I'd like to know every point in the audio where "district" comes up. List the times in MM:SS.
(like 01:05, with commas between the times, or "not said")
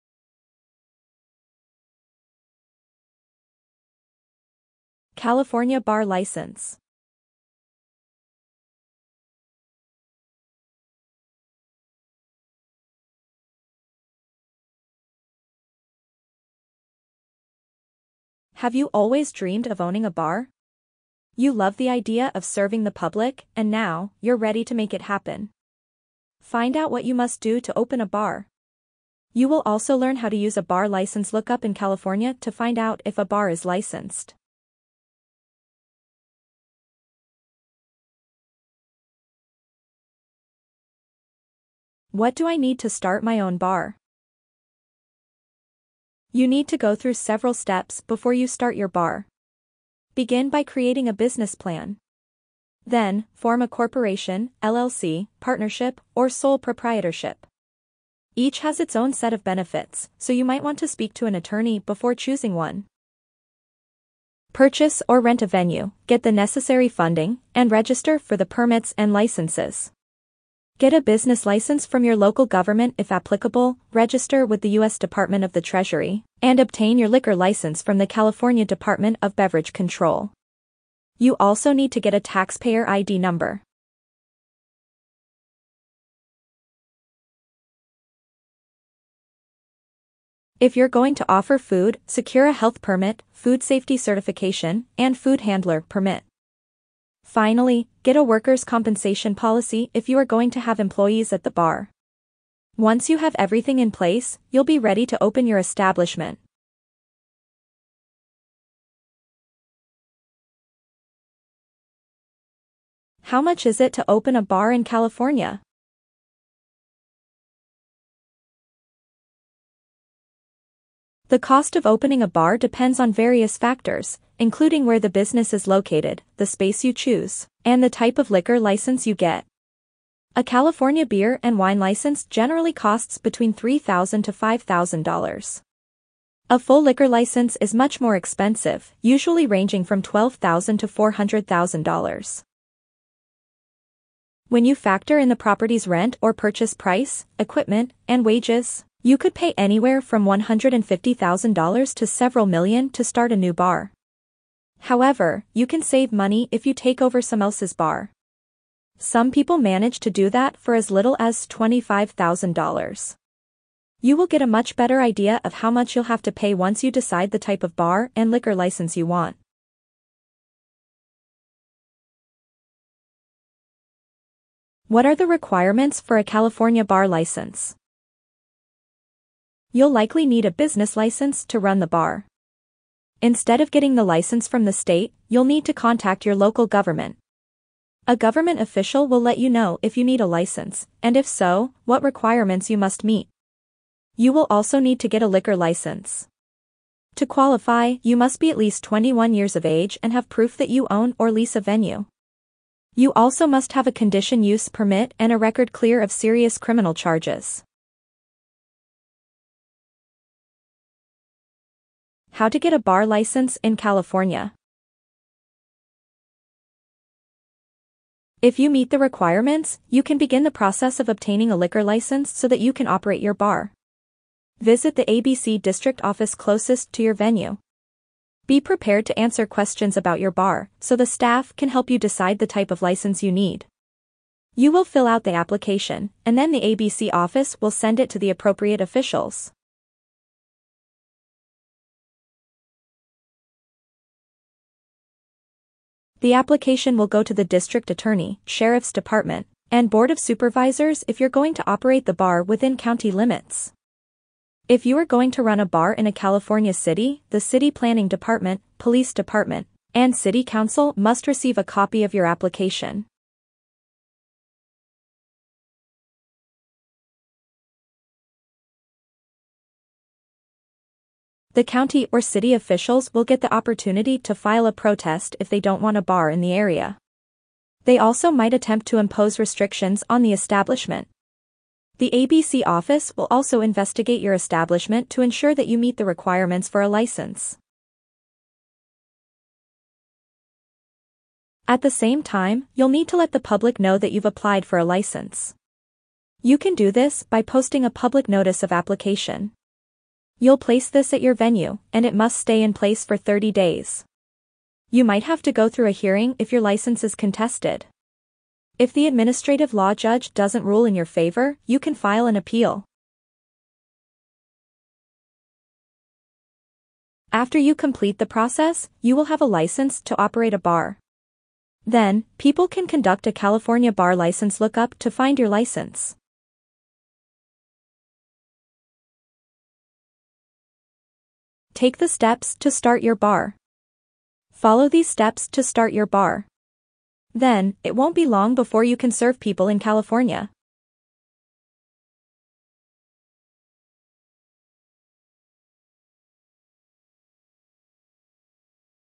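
03:45, 04:07.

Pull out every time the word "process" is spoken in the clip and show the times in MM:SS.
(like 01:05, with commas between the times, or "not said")
03:40, 05:18.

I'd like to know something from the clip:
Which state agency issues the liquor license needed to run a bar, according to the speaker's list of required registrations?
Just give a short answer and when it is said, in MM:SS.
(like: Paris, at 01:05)
California Department of Beverage Control, at 01:18.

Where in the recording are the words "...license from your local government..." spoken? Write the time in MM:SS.
01:11.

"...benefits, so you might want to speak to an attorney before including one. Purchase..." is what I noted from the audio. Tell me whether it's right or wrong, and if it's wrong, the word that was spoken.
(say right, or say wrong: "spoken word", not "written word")
wrong: "choosing", not "including".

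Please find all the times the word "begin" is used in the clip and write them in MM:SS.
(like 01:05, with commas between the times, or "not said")
00:50, 03:40.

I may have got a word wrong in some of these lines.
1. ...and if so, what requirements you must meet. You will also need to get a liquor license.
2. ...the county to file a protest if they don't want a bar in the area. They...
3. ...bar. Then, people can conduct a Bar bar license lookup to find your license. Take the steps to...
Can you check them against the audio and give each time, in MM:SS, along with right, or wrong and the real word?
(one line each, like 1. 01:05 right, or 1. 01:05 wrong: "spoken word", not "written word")
1. 03:11 right
2. 04:33 wrong: "opportunity", not "county"
3. 05:20 wrong: "California", not "Bar".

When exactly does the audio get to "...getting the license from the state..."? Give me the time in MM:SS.
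03:03.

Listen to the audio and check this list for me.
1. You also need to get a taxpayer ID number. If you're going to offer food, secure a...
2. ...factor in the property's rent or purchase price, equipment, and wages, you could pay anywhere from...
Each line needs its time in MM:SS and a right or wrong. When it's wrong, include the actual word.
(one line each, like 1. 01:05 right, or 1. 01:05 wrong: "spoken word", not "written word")
1. 01:21 right
2. 02:24 right.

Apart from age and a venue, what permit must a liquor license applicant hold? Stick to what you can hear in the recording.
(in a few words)
condition use permit.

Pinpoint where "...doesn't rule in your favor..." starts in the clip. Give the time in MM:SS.
05:10.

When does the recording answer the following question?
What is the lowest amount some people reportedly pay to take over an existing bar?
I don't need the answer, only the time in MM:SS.
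02:41.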